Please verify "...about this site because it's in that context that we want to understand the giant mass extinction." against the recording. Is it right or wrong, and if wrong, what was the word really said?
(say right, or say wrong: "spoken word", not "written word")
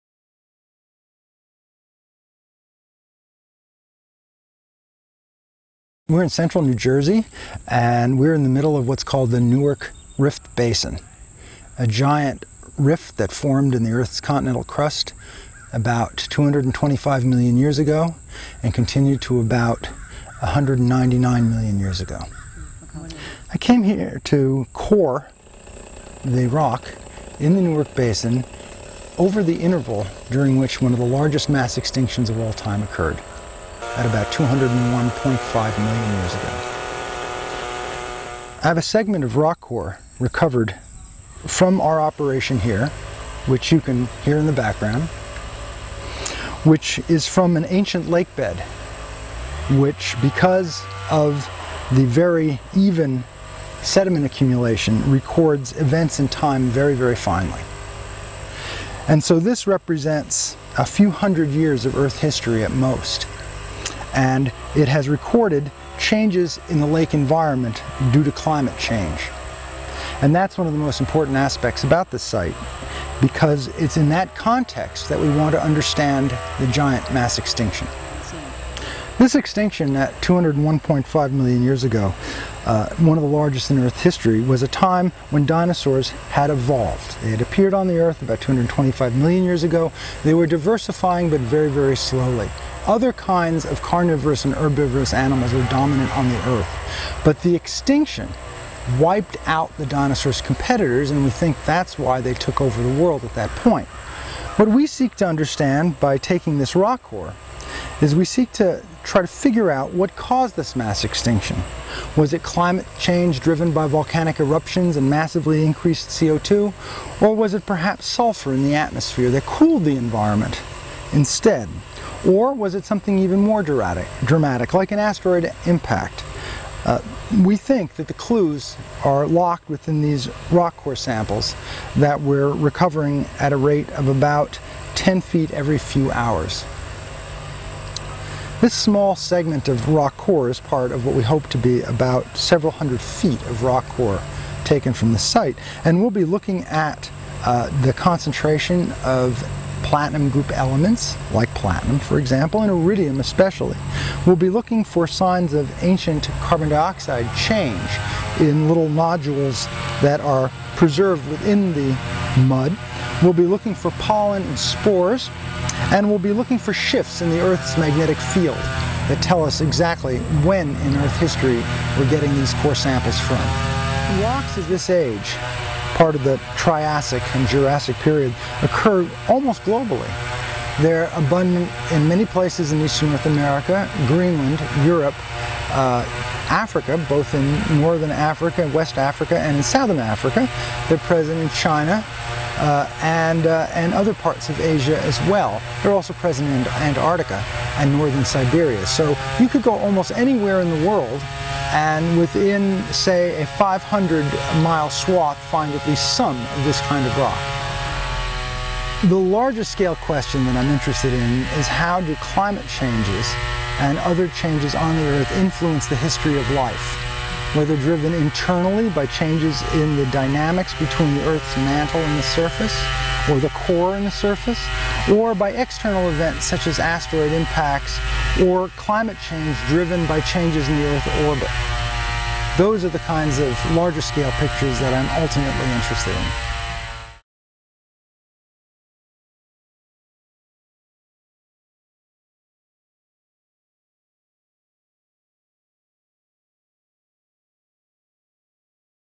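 right.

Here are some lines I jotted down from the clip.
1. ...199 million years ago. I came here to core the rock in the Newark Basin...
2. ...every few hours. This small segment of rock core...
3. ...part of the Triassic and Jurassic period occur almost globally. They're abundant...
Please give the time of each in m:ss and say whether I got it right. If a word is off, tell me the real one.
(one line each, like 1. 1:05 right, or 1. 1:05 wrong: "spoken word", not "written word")
1. 0:20 right
2. 2:15 right
3. 2:56 right.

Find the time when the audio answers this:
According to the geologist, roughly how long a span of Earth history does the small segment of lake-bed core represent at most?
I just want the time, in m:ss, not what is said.
1:00.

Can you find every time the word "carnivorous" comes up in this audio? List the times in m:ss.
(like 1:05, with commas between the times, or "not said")
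1:33.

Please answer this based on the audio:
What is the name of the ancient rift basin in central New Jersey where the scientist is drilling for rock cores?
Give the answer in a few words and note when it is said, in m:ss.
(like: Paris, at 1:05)
Newark Rift Basin, at 0:09.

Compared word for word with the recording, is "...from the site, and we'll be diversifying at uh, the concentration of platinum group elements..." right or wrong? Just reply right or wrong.
wrong.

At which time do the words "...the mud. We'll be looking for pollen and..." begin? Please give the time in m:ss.
2:41.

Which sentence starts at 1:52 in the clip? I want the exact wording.
Was it climate change driven by volcanic eruptions and massively increased CO2?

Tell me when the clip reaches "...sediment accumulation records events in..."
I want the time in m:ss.
0:53.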